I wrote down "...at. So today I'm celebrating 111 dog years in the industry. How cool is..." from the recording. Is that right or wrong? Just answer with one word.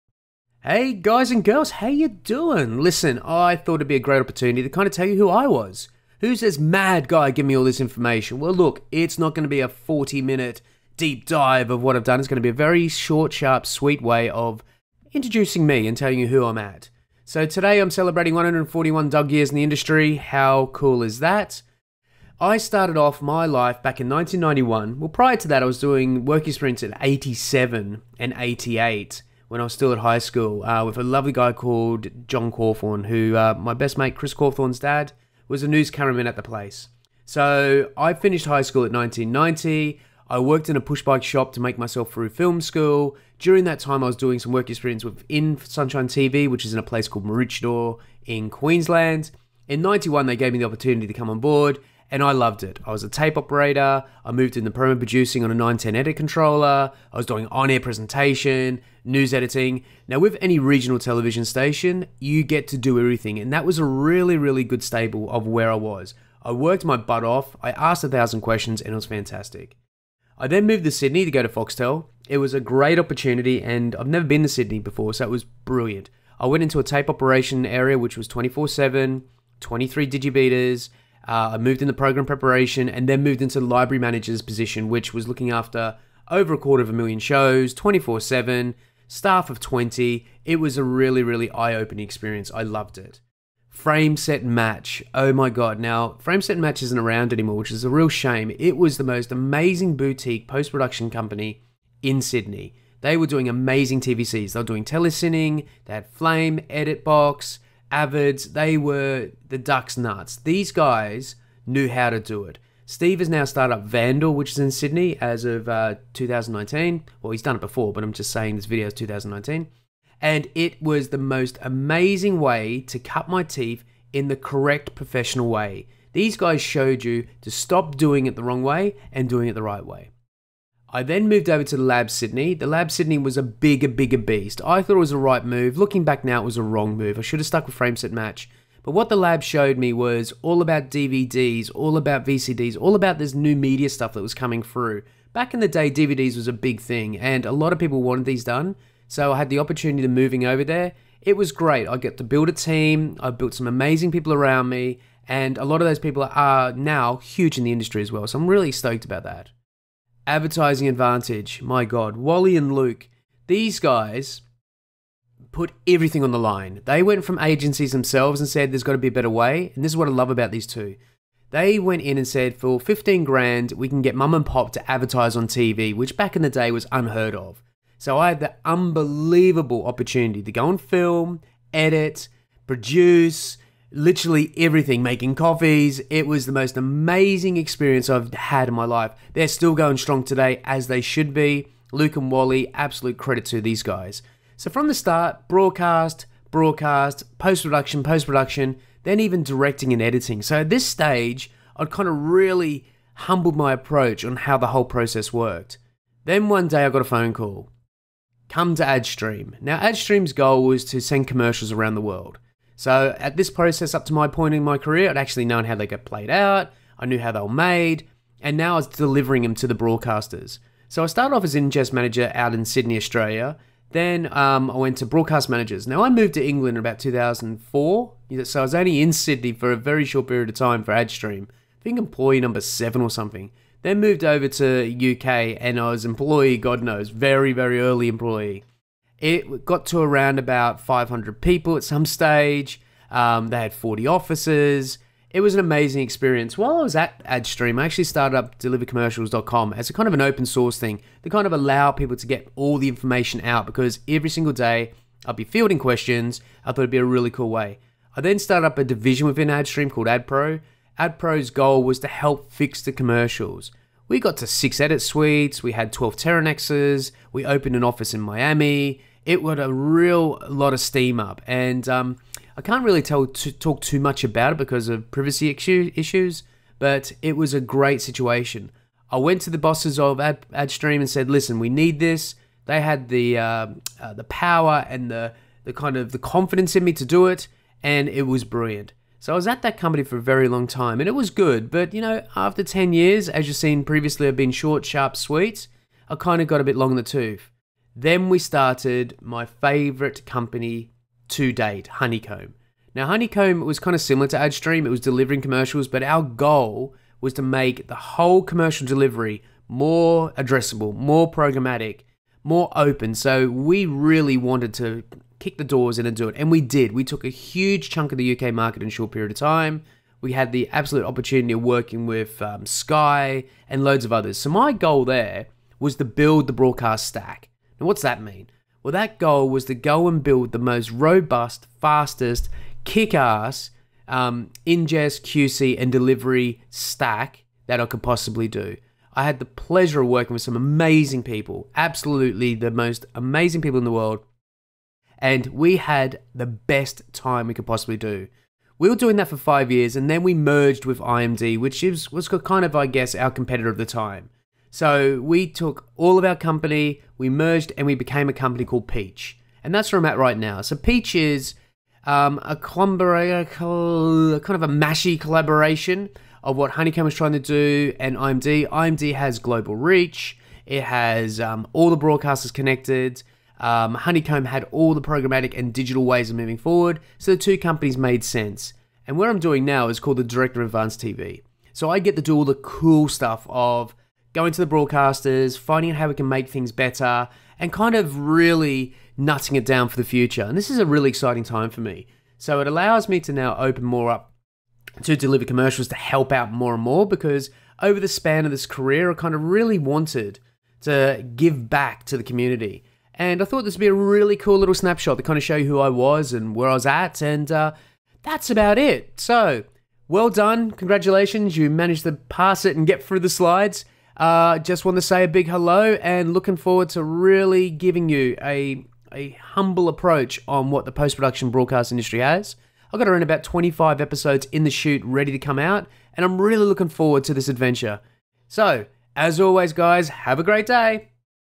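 wrong.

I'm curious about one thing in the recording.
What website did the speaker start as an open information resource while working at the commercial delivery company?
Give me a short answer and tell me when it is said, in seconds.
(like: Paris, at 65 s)
delivercommercials.com, at 248 s.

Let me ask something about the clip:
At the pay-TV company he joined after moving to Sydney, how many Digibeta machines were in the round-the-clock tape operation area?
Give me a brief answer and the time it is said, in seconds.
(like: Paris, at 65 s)
23, at 79 s.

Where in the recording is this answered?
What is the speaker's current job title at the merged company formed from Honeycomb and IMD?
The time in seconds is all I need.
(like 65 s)
380 s.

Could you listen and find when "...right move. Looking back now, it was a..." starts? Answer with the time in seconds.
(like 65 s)
135 s.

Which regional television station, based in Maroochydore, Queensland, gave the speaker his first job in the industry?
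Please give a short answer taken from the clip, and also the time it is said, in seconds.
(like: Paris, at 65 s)
Sunshine TV, at 45 s.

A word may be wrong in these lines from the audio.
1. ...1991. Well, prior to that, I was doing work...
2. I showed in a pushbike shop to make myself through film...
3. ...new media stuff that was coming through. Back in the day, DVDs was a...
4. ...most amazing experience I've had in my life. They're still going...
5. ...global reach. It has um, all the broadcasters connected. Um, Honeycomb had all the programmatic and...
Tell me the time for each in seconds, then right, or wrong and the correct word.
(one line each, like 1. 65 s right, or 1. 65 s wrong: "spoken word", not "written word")
1. 24 s right
2. 40 s wrong: "worked", not "showed"
3. 143 s right
4. 186 s right
5. 369 s right.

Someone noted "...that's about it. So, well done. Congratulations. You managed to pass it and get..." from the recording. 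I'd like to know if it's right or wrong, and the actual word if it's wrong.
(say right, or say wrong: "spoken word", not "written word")
right.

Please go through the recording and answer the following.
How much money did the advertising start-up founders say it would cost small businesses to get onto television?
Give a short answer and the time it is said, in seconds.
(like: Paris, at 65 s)
15 grand, at 172 s.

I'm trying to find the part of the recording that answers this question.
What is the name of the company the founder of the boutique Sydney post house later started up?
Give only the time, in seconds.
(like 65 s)
113 s.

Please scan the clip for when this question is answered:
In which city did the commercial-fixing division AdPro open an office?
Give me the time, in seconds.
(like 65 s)
268 s.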